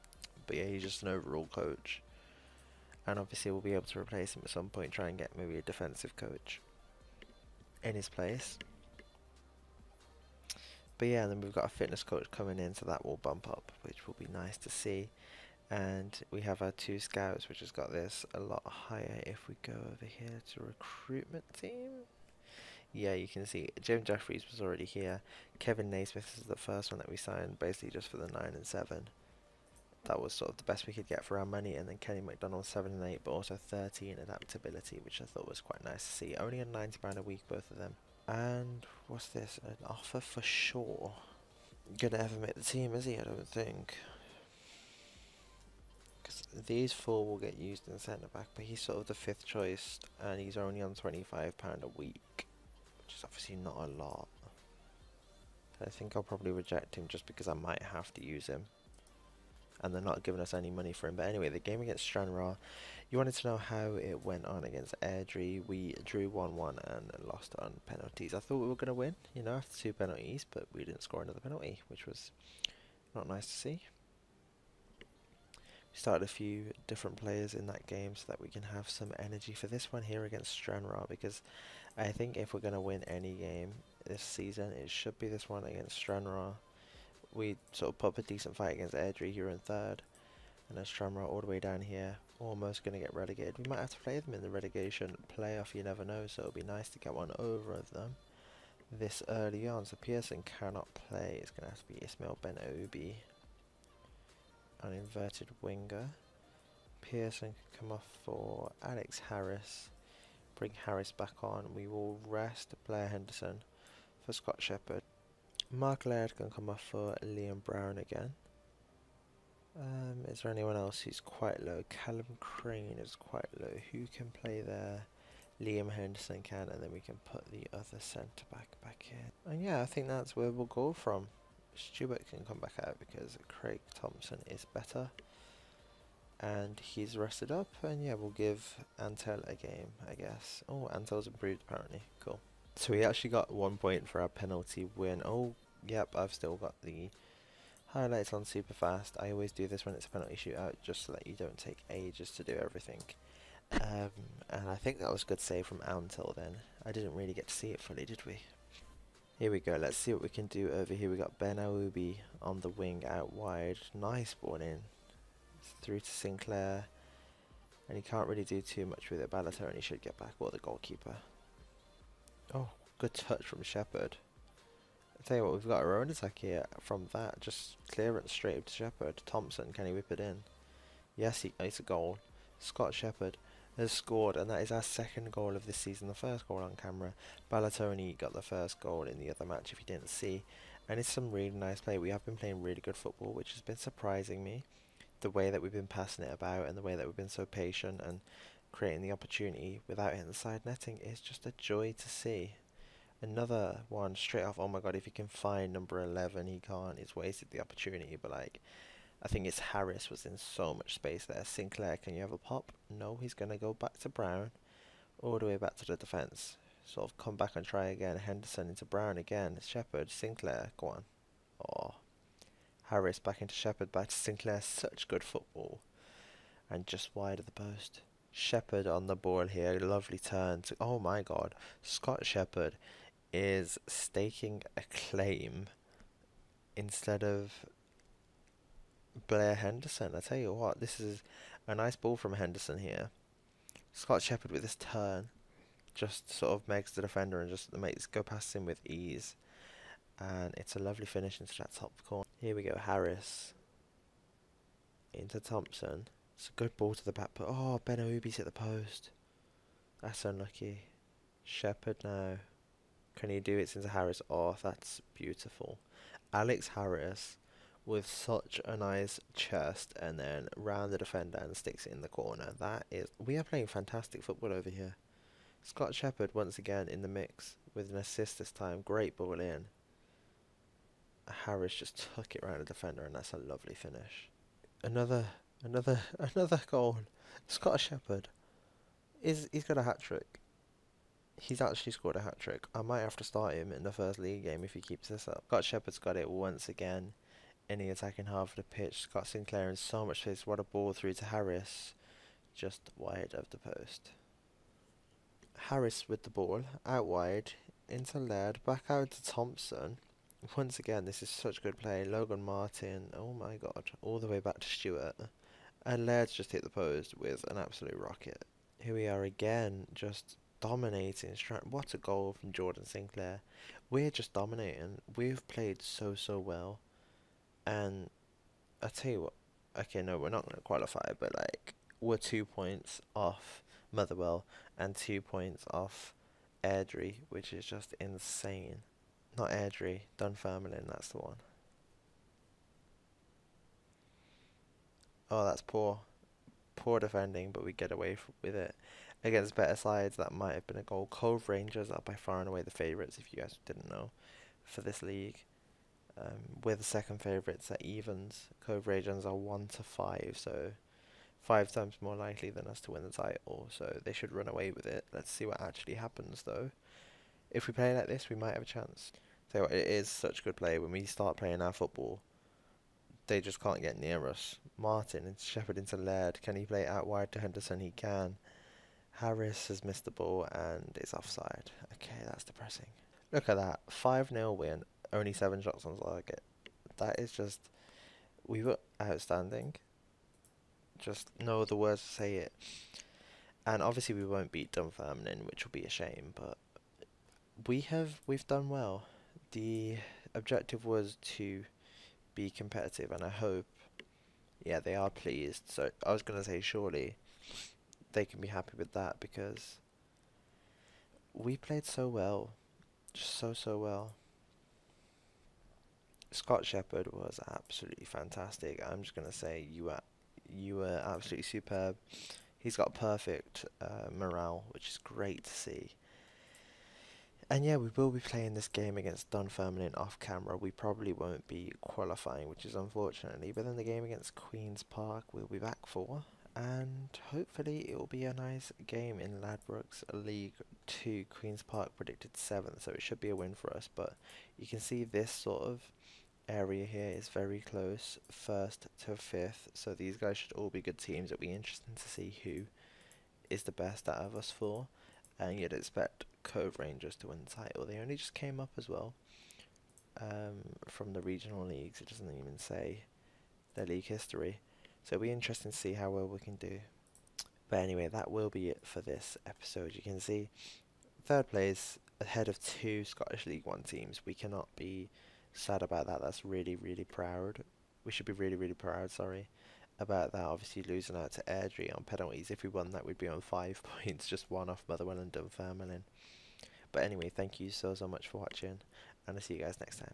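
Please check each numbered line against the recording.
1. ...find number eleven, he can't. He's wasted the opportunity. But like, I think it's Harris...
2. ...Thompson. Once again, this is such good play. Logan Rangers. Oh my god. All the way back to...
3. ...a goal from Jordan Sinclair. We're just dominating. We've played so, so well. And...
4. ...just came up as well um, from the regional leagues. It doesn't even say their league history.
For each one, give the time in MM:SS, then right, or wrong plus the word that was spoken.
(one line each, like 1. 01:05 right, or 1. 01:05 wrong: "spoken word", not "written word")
1. 03:25 right
2. 05:09 wrong: "Martin", not "Rangers"
3. 05:21 right
4. 07:38 right.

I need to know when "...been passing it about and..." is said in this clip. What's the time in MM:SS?
03:15.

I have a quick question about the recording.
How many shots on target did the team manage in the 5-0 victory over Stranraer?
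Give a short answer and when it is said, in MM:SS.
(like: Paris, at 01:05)
7, at 06:25.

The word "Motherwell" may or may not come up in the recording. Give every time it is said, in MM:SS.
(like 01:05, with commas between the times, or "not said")
05:33, 08:04.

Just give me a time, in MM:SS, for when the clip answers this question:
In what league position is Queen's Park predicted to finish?
07:21.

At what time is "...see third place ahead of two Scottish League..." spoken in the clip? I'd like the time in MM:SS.
07:50.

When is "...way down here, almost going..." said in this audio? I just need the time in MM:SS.
01:31.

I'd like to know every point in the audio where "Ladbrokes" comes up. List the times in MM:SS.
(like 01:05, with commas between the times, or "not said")
07:19.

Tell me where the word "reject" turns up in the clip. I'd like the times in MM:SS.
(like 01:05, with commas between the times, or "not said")
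00:56.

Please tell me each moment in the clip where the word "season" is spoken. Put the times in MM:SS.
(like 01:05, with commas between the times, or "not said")
01:24, 03:05.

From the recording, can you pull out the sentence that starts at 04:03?
Scott Shepherd with this turn just sort of makes the defender and just makes go past him with ease.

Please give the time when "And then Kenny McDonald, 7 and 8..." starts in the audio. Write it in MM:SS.
00:31.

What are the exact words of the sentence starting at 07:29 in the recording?
So these guys should all be good teams.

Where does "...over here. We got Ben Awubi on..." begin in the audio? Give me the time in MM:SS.
02:40.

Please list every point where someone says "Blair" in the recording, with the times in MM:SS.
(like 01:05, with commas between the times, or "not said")
01:52, 03:59.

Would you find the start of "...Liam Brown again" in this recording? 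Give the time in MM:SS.
01:57.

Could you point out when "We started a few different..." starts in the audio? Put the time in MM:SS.
01:14.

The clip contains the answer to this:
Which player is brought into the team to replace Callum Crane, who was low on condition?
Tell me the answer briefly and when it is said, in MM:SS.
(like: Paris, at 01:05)
Liam Henderson, at 02:05.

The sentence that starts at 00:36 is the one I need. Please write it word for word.
Only a £90 a week, both of them.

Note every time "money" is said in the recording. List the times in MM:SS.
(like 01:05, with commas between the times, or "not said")
00:31, 01:00.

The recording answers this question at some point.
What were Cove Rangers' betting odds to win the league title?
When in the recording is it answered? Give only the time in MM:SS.
05:59.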